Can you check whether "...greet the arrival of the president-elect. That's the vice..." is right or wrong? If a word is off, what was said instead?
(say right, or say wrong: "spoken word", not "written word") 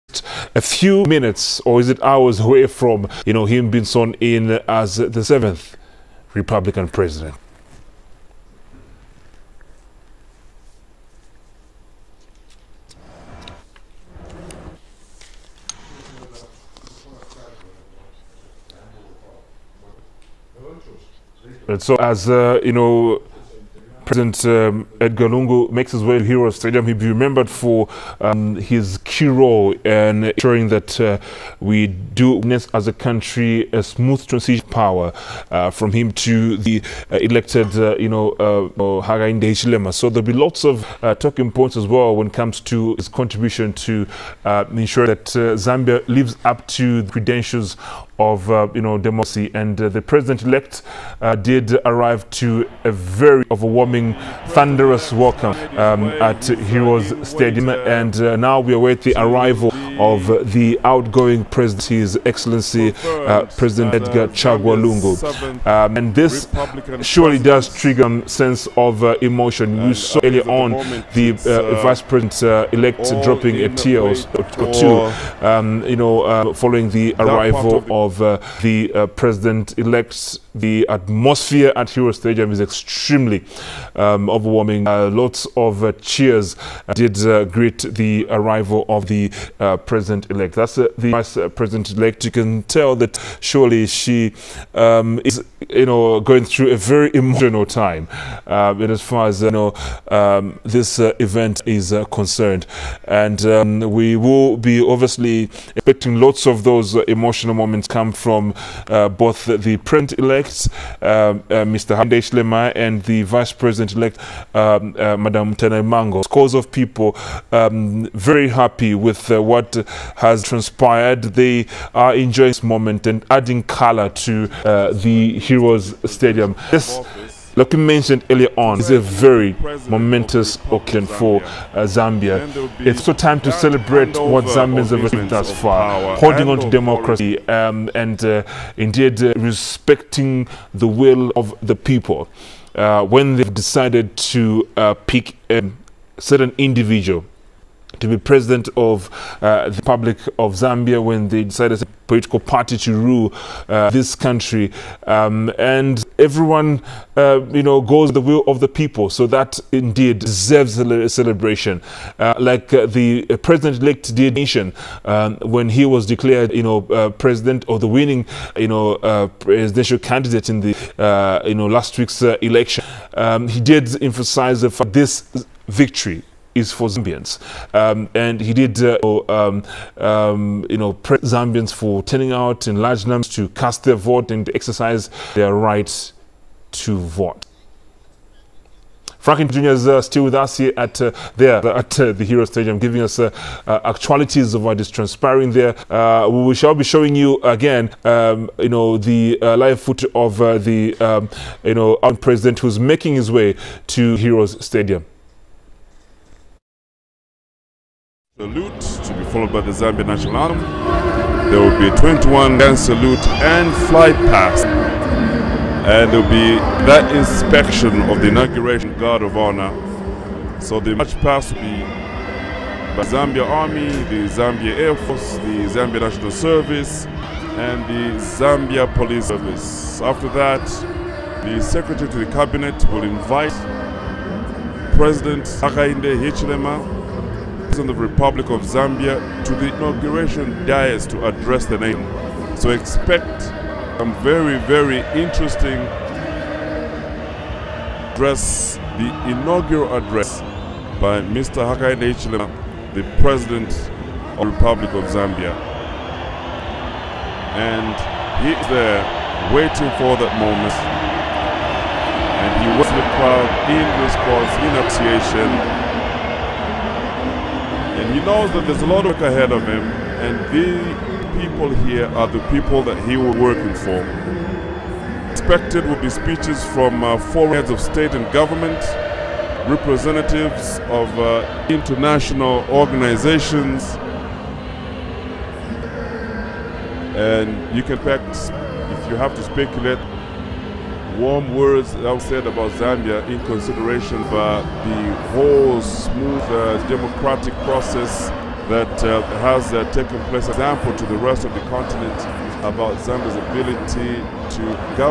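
right.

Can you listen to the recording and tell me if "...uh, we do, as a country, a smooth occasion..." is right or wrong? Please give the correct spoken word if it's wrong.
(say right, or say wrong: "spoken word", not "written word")
wrong: "transition", not "occasion".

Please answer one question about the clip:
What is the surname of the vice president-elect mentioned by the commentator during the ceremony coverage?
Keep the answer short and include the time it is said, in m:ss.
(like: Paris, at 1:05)
Nalumango, at 1:55.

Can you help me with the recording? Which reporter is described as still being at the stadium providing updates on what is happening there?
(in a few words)
Franklin Jr.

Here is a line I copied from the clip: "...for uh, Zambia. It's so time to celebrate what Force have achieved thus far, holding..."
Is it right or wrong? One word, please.
wrong.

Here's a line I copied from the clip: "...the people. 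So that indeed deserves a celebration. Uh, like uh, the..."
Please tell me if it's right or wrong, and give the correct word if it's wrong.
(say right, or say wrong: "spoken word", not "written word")
right.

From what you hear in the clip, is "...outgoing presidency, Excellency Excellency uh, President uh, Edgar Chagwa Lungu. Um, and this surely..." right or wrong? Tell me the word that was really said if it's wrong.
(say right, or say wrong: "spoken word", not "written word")
wrong: "His", not "Excellency".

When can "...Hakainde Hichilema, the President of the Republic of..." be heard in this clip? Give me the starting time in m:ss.
4:11.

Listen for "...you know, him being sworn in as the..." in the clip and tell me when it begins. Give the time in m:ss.
0:03.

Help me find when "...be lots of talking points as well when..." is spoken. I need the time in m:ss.
0:40.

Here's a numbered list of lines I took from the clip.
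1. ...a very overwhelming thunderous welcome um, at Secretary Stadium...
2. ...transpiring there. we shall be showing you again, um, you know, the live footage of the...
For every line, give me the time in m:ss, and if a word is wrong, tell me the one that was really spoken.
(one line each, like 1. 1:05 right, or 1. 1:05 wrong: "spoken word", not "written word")
1. 0:52 wrong: "Heroes", not "Secretary"
2. 3:14 right.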